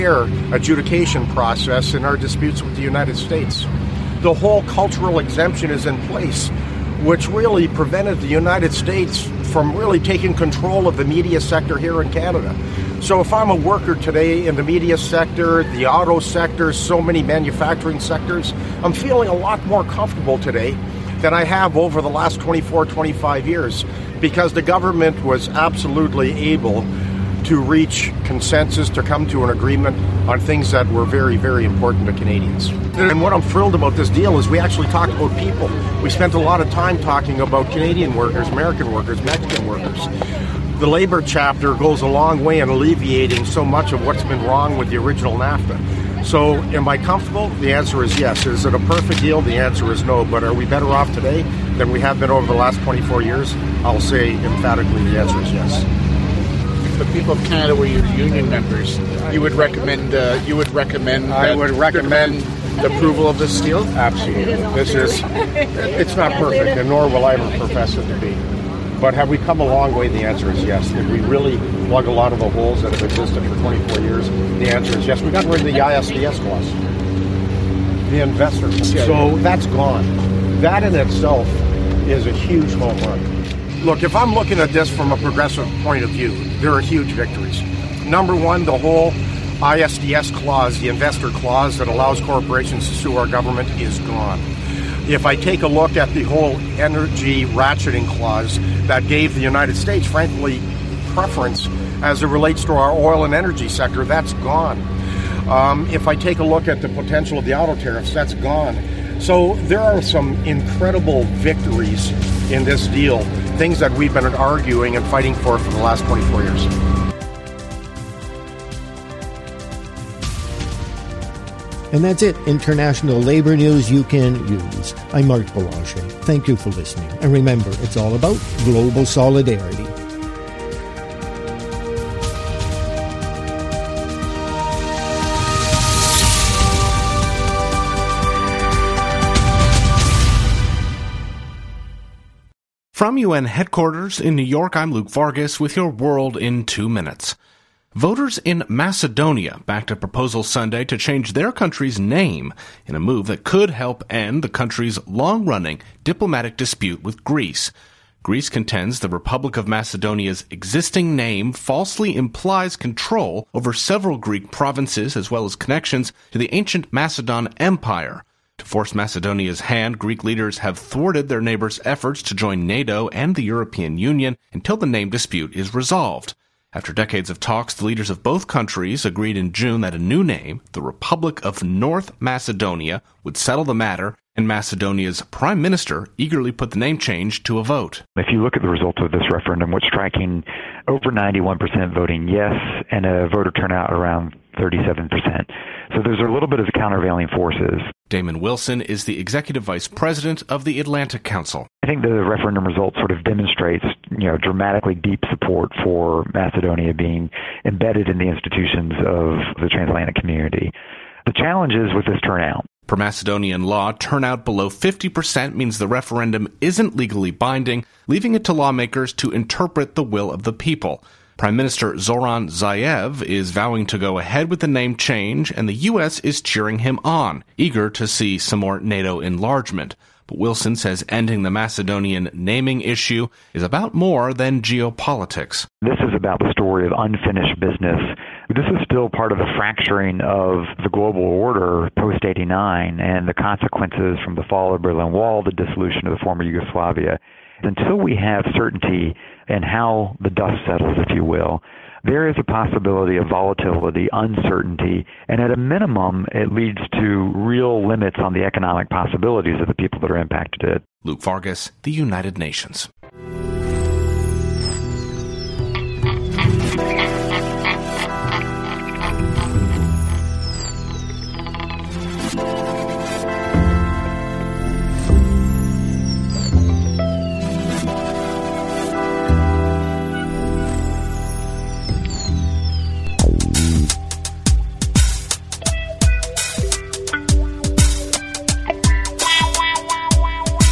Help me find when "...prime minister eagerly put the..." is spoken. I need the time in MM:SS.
03:05.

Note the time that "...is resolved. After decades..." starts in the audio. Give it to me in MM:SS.
02:55.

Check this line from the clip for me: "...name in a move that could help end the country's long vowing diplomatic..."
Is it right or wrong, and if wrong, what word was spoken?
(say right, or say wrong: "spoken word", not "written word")
wrong: "running", not "vowing".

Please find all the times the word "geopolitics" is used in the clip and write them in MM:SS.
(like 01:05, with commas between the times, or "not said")
03:54.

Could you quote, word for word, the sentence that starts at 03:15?
So there's a little bit of countervailing forces.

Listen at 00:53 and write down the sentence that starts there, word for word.
I'll say emphatically the answer is yes.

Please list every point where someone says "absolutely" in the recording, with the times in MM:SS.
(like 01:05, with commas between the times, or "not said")
00:25, 01:03.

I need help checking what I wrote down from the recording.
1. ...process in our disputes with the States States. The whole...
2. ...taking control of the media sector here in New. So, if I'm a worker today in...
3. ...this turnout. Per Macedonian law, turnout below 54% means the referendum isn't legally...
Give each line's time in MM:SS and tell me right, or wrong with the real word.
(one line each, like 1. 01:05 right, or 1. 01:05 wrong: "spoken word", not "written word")
1. 00:01 wrong: "United", not "States"
2. 00:09 wrong: "Canada", not "New"
3. 03:32 wrong: "50", not "54".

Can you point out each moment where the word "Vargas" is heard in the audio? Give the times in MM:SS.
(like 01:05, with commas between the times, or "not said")
02:25, 04:21.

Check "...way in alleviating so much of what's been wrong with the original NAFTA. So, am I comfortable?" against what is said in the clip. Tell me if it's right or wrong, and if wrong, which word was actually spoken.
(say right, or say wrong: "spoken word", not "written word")
right.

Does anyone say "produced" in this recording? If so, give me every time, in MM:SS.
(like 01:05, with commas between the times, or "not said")
not said.